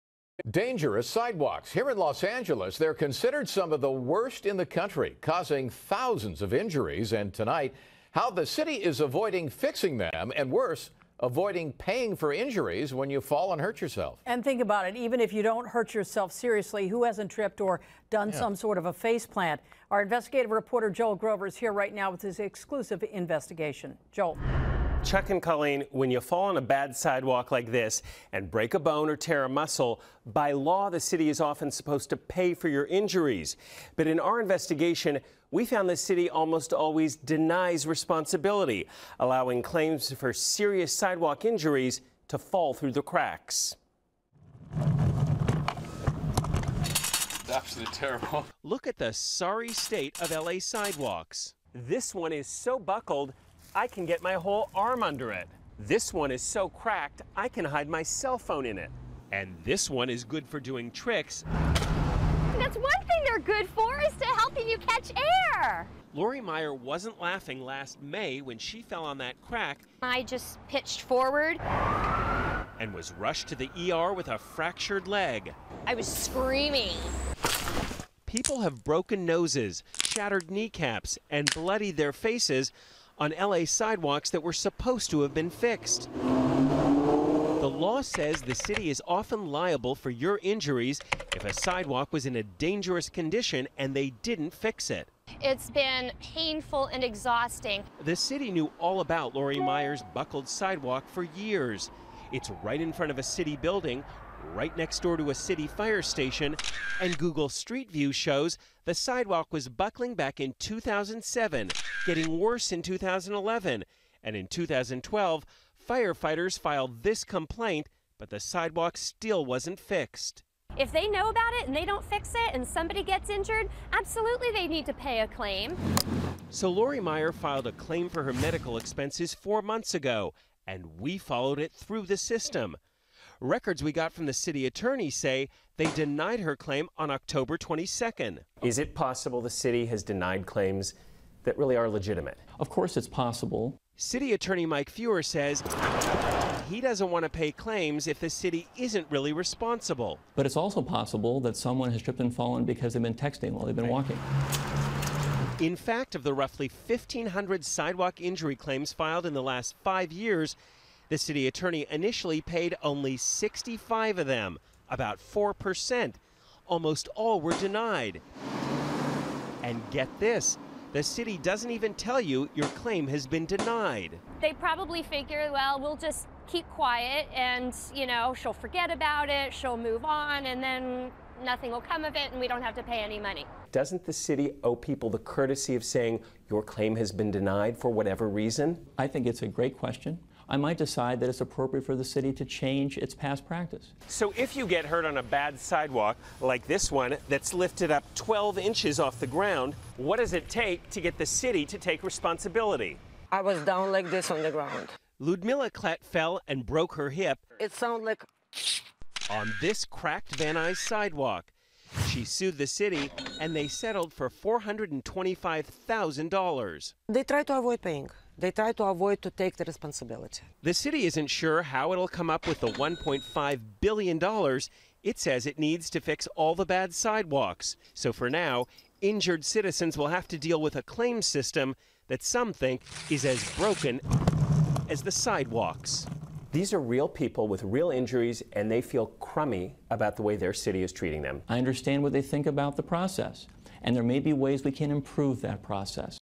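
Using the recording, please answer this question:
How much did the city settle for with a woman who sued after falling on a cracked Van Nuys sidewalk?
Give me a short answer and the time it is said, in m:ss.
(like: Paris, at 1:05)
$425,000, at 3:34.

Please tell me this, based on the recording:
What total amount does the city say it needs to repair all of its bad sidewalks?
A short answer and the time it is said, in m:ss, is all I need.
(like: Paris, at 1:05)
$1.5 billion, at 3:42.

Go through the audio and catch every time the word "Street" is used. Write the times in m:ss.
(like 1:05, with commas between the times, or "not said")
1:47.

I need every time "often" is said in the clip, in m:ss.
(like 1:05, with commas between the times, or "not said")
0:31, 1:29.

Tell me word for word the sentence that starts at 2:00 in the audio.
If they know about it and they don't fix it and somebody gets injured, absolutely they need to pay a claim.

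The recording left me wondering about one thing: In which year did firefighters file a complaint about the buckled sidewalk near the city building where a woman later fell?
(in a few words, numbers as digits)
2012.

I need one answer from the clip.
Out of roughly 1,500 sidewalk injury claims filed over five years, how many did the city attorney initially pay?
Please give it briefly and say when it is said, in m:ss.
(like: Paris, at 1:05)
65, at 2:43.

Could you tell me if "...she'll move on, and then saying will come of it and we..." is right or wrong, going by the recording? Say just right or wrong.
wrong.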